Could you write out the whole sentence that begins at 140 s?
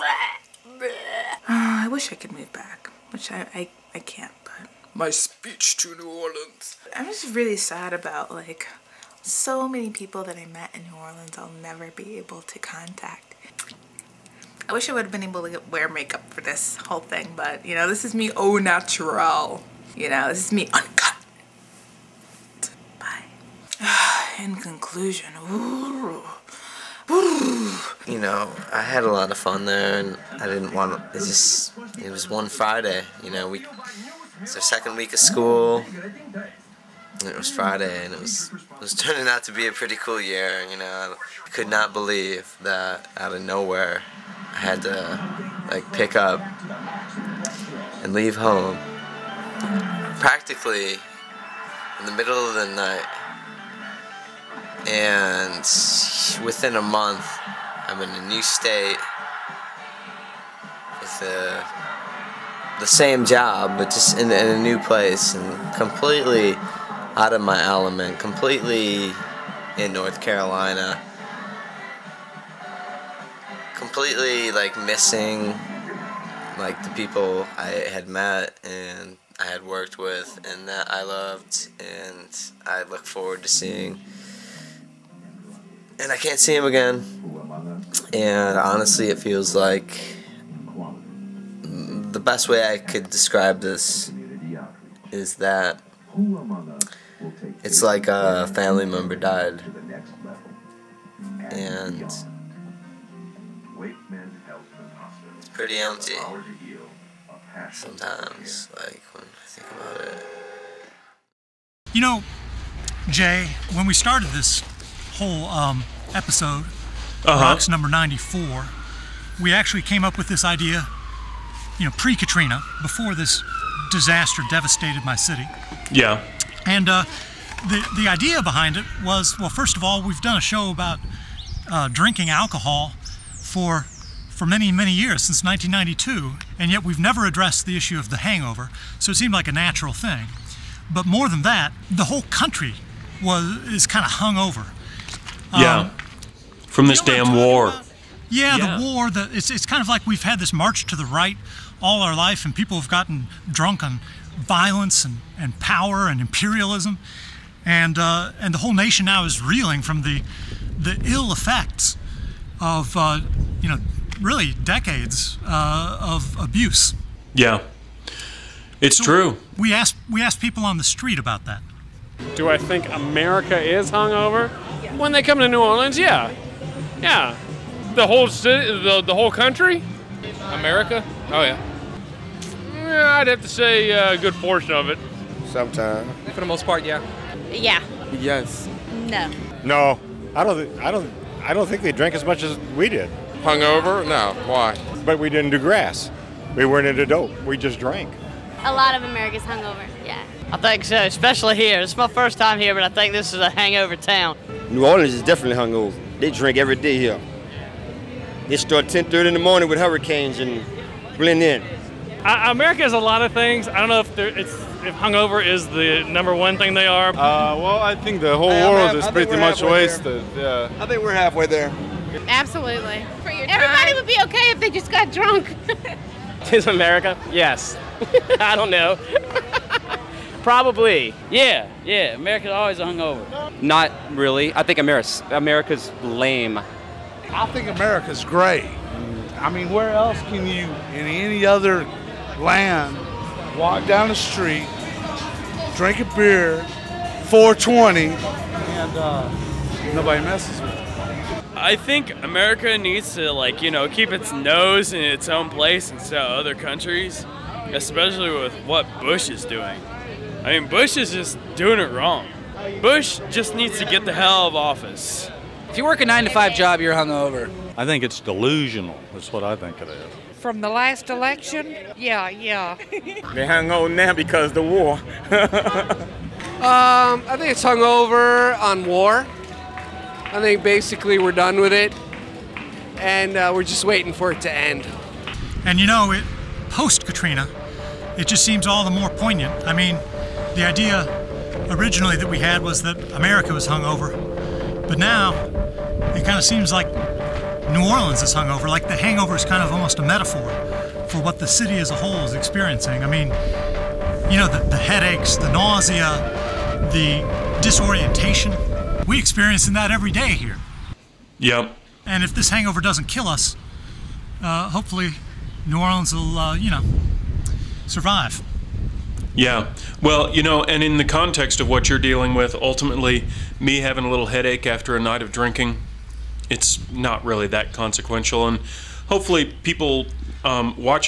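But more than that, the whole country was, is kind of hung over.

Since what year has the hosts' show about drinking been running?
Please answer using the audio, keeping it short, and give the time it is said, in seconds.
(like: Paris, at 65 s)
1992, at 135 s.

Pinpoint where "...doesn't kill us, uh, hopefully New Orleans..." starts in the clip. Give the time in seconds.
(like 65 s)
312 s.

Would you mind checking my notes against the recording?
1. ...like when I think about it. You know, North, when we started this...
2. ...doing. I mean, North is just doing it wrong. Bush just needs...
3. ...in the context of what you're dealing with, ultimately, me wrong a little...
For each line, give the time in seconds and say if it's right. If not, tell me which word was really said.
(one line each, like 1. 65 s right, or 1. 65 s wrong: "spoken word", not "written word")
1. 108 s wrong: "Jay", not "North"
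2. 259 s wrong: "Bush", not "North"
3. 320 s wrong: "having", not "wrong".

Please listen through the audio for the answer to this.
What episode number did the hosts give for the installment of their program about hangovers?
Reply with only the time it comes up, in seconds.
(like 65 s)
117 s.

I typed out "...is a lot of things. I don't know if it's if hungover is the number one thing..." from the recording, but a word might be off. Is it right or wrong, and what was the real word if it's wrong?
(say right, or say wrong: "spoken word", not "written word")
right.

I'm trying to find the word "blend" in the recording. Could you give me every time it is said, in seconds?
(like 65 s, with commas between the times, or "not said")
211 s.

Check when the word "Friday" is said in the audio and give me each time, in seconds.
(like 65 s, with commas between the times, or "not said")
32 s, 37 s.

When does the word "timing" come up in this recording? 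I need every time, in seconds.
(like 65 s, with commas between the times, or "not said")
not said.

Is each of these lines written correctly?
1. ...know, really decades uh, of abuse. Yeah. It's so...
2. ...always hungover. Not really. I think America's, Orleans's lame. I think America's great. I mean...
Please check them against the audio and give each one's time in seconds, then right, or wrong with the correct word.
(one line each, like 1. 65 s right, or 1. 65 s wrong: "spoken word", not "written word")
1. 163 s right
2. 232 s wrong: "America", not "Orleans".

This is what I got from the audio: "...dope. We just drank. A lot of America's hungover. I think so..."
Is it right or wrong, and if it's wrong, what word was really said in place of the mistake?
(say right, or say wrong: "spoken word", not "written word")
right.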